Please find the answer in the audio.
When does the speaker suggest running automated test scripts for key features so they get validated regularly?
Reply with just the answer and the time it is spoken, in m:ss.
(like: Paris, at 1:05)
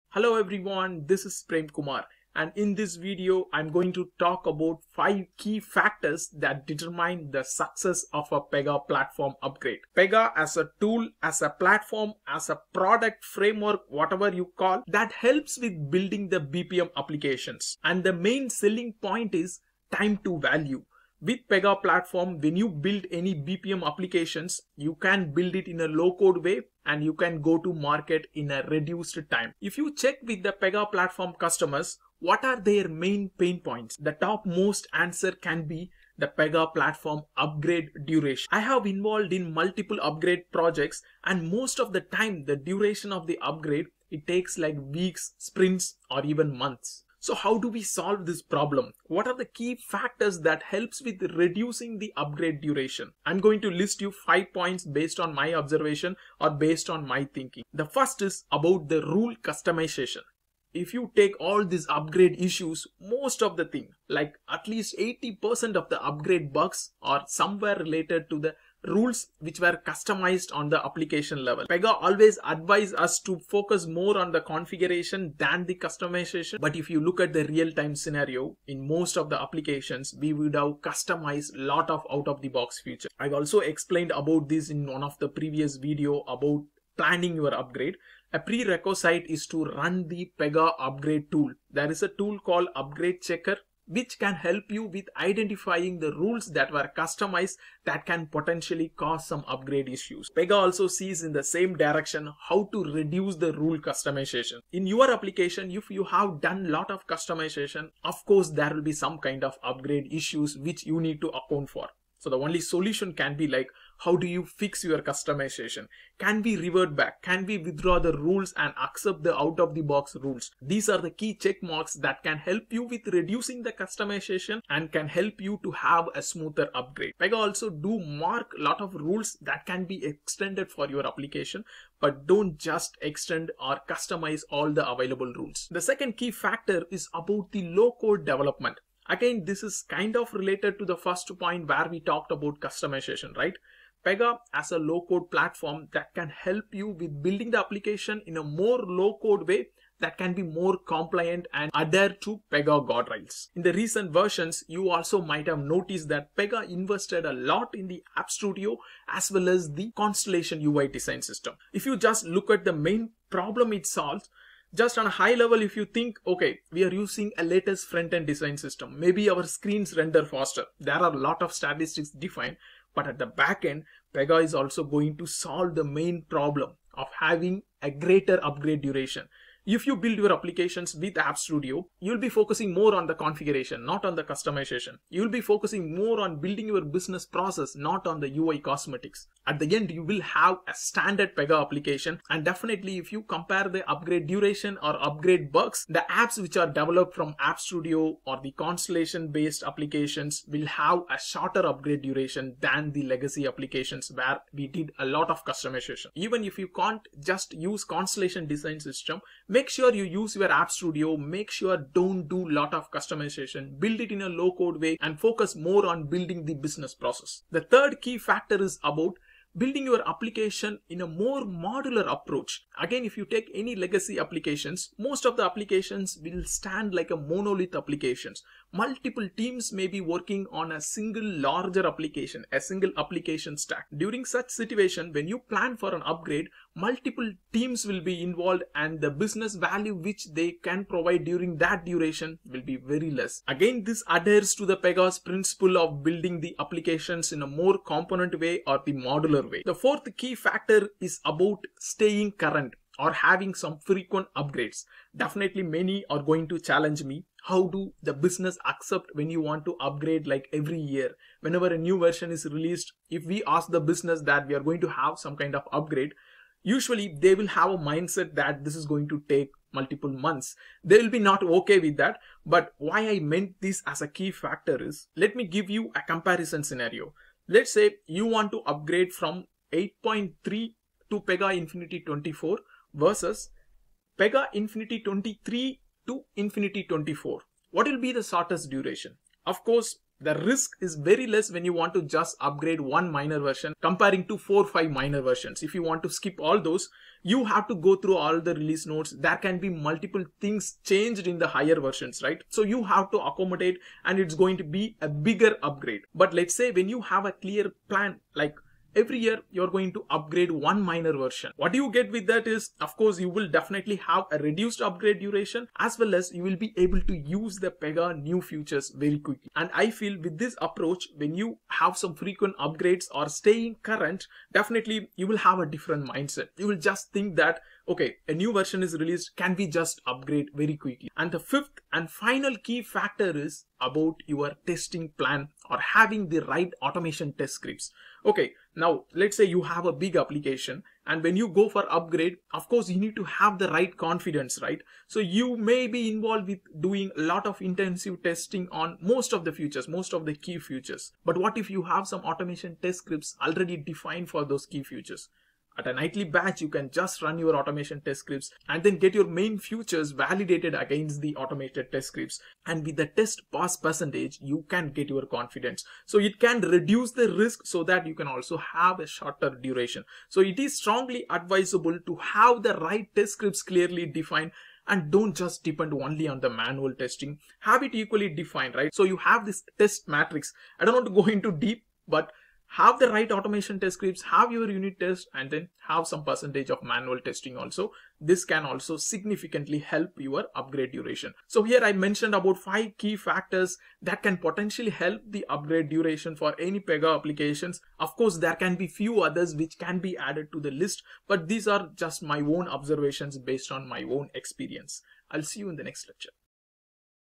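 at a nightly batch, at 5:55.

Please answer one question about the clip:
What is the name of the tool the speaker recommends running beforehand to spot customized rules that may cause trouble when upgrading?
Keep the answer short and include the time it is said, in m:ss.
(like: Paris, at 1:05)
upgrade checker, at 1:32.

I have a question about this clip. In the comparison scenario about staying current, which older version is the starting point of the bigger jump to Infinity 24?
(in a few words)
8.3.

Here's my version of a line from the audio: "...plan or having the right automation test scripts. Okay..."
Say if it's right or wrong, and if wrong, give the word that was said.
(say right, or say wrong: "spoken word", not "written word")
right.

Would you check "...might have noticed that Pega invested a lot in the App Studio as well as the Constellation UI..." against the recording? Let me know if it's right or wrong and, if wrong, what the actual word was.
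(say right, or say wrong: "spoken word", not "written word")
right.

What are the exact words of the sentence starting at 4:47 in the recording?
What will be the shortest duration?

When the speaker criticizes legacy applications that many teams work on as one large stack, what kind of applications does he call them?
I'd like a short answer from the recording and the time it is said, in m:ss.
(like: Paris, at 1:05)
monolith applications, at 3:47.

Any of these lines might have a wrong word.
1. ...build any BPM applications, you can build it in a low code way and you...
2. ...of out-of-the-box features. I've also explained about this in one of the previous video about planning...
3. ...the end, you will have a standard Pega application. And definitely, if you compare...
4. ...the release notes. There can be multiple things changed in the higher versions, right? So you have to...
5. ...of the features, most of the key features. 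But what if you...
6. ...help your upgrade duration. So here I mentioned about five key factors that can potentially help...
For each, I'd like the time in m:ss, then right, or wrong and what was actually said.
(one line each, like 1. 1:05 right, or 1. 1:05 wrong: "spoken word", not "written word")
1. 0:22 right
2. 1:21 right
3. 3:09 right
4. 4:58 right
5. 5:49 right
6. 6:29 right.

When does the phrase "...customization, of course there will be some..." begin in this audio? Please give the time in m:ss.
1:47.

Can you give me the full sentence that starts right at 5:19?
And I feel with this approach, when you have some frequent upgrades or staying current, definitely you will have a different mindset.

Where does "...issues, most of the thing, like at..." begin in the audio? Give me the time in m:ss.
1:02.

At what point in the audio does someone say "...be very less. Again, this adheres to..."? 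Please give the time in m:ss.
4:02.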